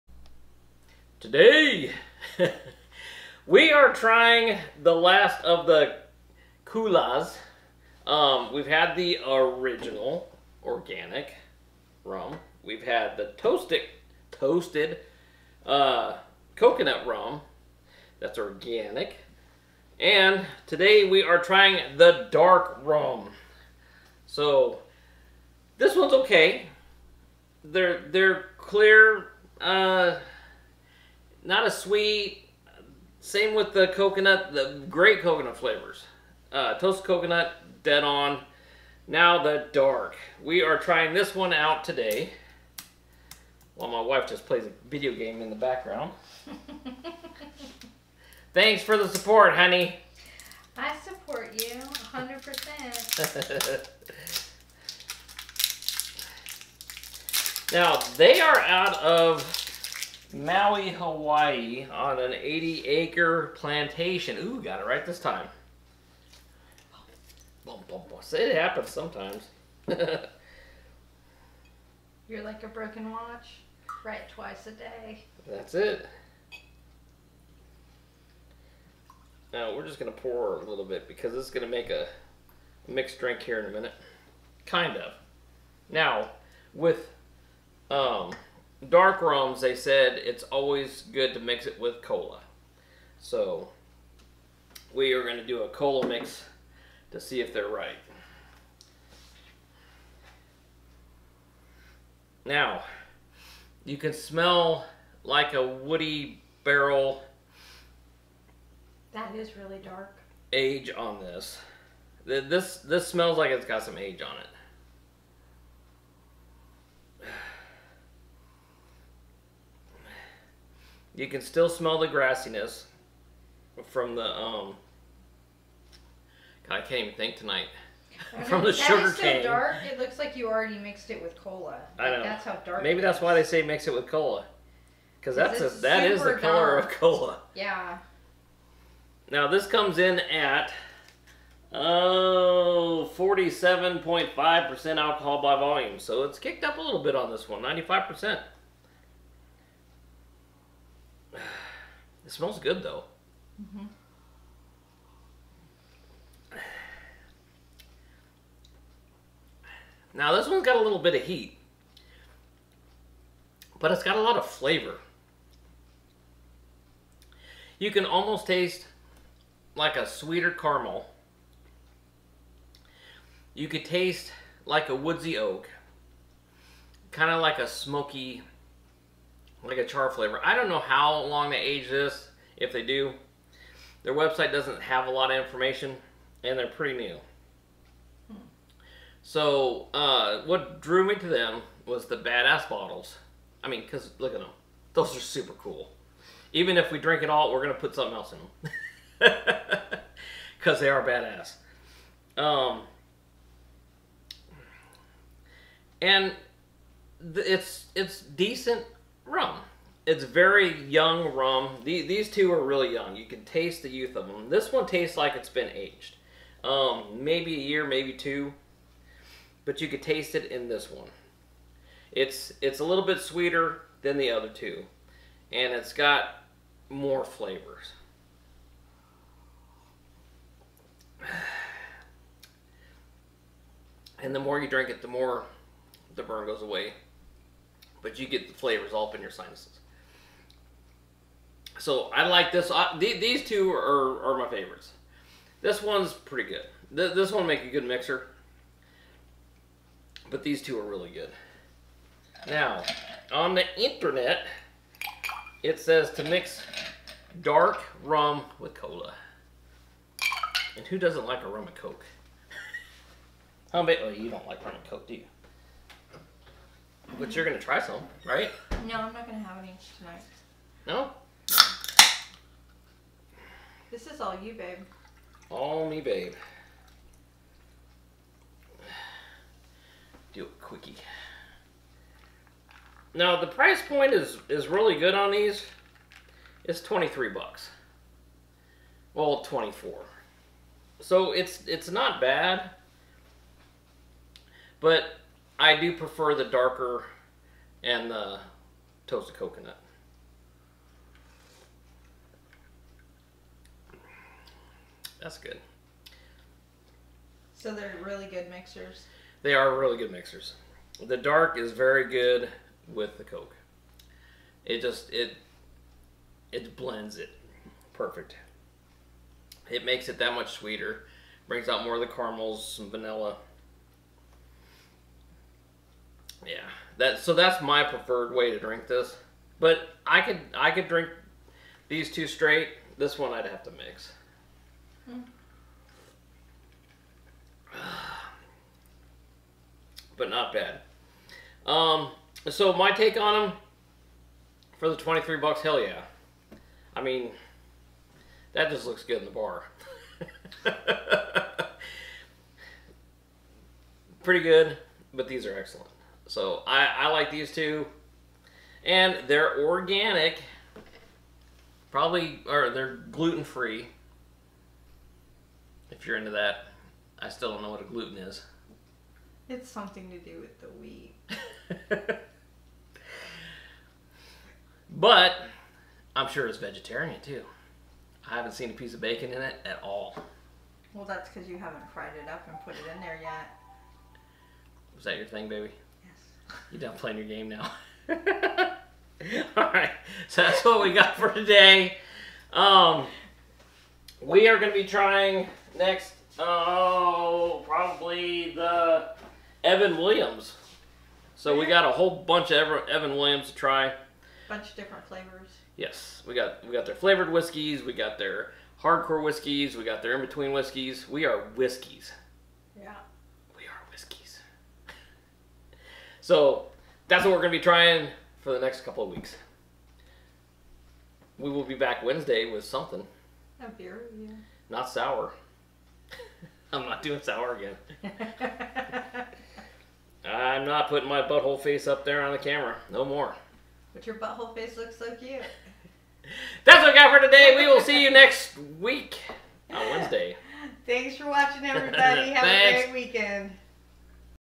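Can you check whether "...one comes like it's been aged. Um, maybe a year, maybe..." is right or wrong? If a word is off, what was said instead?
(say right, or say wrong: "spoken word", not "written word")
wrong: "tastes", not "comes".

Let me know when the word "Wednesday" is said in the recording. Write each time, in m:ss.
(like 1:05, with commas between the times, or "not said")
7:02, 7:19.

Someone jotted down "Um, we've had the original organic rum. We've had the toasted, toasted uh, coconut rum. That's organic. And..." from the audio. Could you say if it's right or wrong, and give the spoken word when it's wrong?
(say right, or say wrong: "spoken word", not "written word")
right.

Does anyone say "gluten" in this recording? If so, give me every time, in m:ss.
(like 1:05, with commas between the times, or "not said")
6:03, 6:07.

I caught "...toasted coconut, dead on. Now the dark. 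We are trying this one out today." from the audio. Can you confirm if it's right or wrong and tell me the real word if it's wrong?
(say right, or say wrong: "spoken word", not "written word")
right.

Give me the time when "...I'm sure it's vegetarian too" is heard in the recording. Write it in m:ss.
6:16.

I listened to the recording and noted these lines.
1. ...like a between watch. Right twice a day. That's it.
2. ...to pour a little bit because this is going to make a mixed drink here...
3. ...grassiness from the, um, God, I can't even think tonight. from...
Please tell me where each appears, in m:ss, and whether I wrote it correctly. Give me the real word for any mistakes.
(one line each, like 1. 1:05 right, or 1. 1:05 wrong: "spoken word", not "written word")
1. 1:12 wrong: "broken", not "between"
2. 1:20 right
3. 2:02 right.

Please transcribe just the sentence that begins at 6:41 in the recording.
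So we got a whole bunch of Evan Williams to try.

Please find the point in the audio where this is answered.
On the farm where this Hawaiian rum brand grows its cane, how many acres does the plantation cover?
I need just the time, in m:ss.
1:02.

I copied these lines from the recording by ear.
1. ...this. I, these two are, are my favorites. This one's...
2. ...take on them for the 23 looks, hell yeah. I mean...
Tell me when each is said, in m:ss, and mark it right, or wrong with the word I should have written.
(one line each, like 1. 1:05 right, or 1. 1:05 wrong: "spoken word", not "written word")
1. 4:02 right
2. 5:42 wrong: "bucks", not "looks".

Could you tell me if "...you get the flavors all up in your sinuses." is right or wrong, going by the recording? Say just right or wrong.
right.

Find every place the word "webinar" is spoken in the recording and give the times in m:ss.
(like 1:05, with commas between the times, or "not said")
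not said.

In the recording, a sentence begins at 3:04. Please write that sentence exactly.
Their website doesn't have a lot of information, and they're pretty new.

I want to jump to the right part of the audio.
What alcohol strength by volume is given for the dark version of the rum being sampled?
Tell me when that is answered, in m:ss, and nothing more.
2:23.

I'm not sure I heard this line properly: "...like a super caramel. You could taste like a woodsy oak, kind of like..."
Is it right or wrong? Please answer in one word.
wrong.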